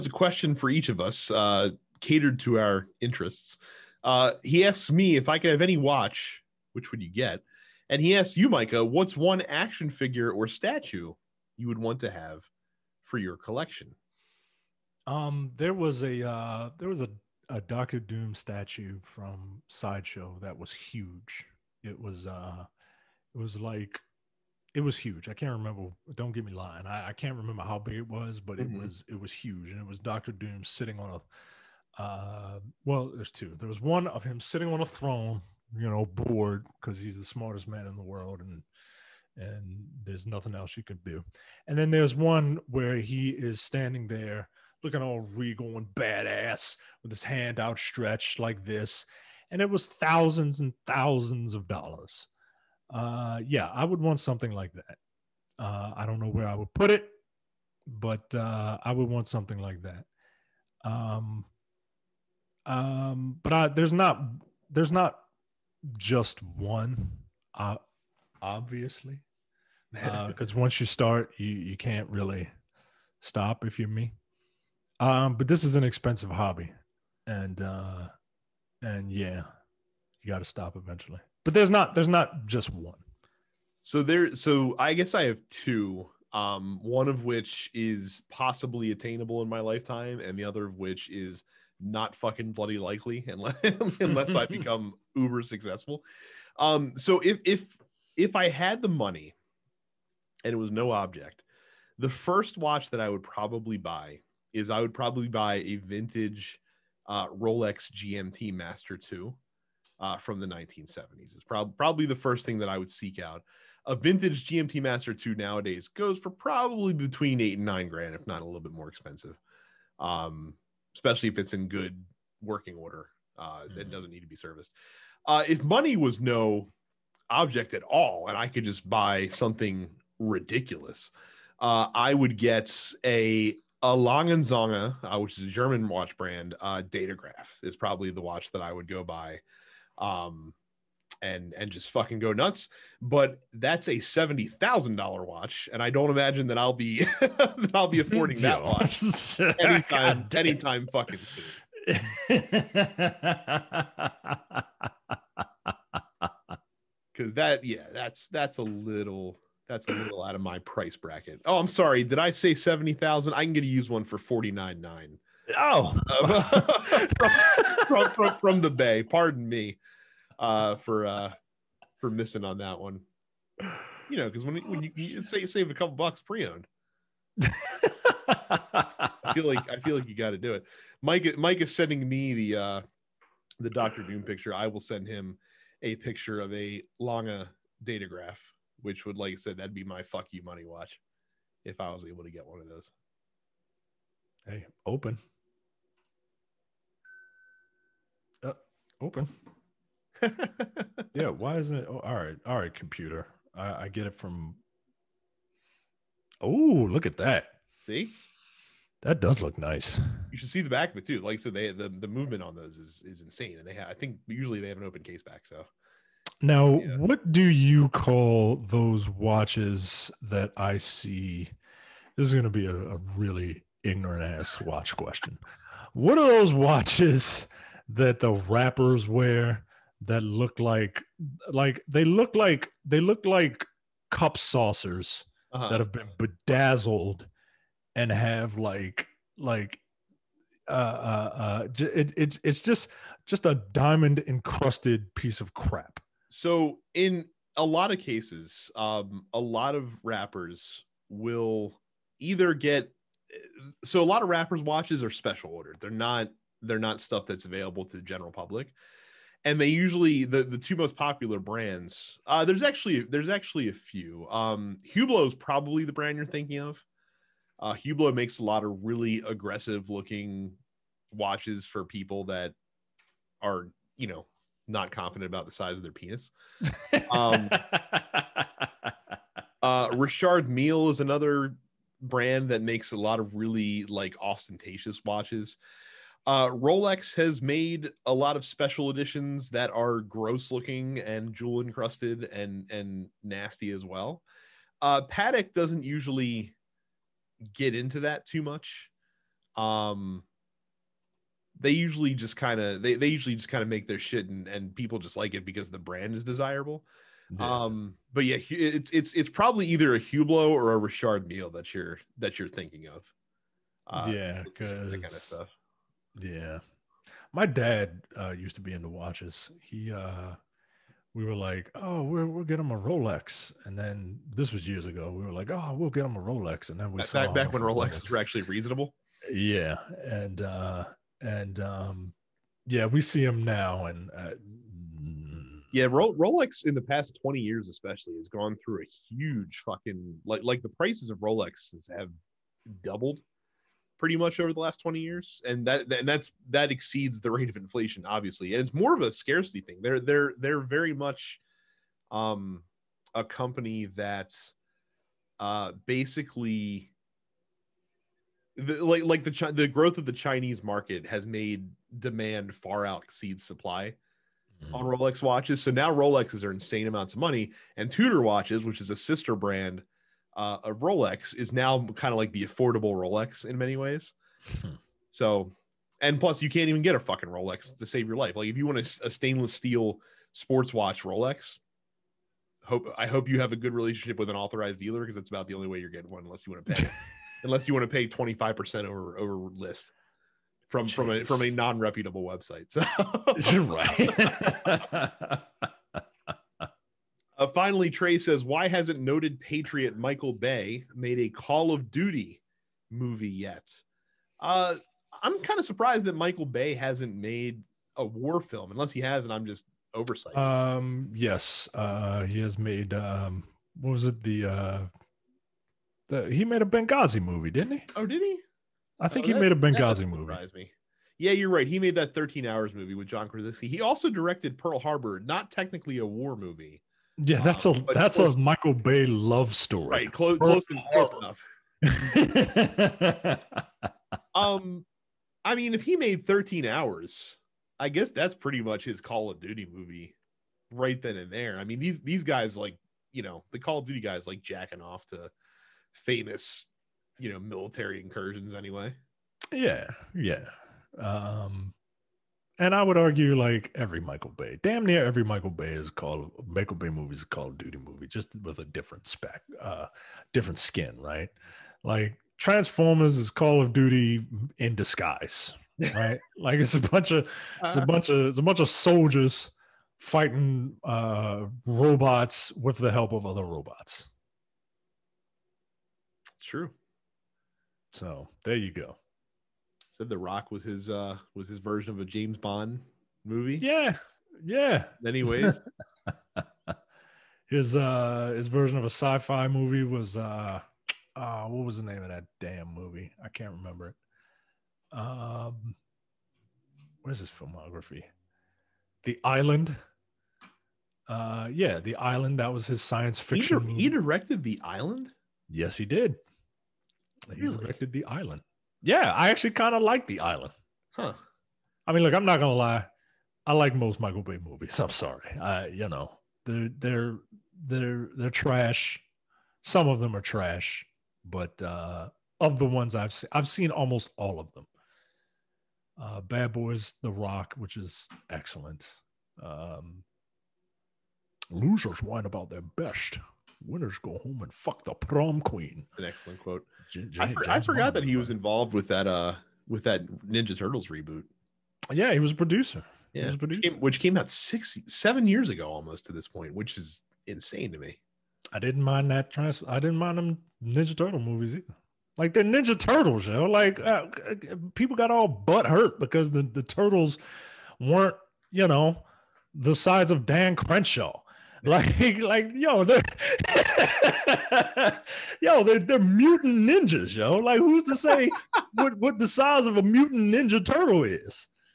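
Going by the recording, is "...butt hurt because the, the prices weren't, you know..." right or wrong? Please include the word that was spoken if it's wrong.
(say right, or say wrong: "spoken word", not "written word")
wrong: "turtles", not "prices".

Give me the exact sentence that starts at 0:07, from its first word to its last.
And he asks you, Micah, what's one action figure or statue you would want to have for your collection?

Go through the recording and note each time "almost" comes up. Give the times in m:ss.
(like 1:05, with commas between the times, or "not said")
8:43, 9:05.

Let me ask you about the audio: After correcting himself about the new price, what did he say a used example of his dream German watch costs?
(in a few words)
$49,900.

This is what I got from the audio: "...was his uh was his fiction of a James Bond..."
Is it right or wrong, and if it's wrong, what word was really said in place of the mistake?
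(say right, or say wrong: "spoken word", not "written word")
wrong: "version", not "fiction".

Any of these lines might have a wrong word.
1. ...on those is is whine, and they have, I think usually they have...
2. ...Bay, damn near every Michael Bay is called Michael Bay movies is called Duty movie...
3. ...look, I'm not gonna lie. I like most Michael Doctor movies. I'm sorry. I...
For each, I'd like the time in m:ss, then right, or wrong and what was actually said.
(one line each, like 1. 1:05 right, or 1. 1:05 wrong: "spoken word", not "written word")
1. 3:32 wrong: "insane", not "whine"
2. 7:34 right
3. 8:32 wrong: "Bay", not "Doctor".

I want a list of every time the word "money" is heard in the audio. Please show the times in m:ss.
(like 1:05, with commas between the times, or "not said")
1:38, 2:05, 3:10, 6:07.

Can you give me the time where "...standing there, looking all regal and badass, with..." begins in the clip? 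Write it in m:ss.
0:43.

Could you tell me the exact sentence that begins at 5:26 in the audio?
And then we back, back when Rolexes Rolex.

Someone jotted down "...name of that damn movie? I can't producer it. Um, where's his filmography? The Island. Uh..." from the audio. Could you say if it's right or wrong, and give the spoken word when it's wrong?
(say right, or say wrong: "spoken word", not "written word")
wrong: "remember", not "producer".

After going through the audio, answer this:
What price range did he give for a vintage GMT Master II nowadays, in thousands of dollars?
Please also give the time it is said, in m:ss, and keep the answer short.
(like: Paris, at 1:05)
8 to 9 thousand, at 1:57.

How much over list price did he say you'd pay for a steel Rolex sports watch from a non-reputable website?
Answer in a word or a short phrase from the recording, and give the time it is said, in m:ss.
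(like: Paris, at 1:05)
25 percent, at 6:28.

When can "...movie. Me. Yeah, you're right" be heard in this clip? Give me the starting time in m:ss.
7:00.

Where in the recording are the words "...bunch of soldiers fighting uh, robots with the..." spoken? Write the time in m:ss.
7:48.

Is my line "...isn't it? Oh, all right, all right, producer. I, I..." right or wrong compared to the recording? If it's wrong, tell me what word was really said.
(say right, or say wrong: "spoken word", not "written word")
wrong: "computer", not "producer".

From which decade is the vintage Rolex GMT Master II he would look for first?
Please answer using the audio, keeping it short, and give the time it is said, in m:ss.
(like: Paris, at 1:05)
1970s, at 1:50.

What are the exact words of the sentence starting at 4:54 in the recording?
Uh, Patek doesn't usually get into that too much.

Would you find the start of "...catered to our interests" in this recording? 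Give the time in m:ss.
0:02.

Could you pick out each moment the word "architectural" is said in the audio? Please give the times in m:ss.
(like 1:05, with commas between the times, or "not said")
not said.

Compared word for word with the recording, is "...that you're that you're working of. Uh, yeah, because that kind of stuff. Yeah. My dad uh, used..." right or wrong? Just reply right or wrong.
wrong.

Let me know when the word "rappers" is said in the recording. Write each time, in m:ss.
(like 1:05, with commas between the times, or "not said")
3:48, 4:10, 4:14.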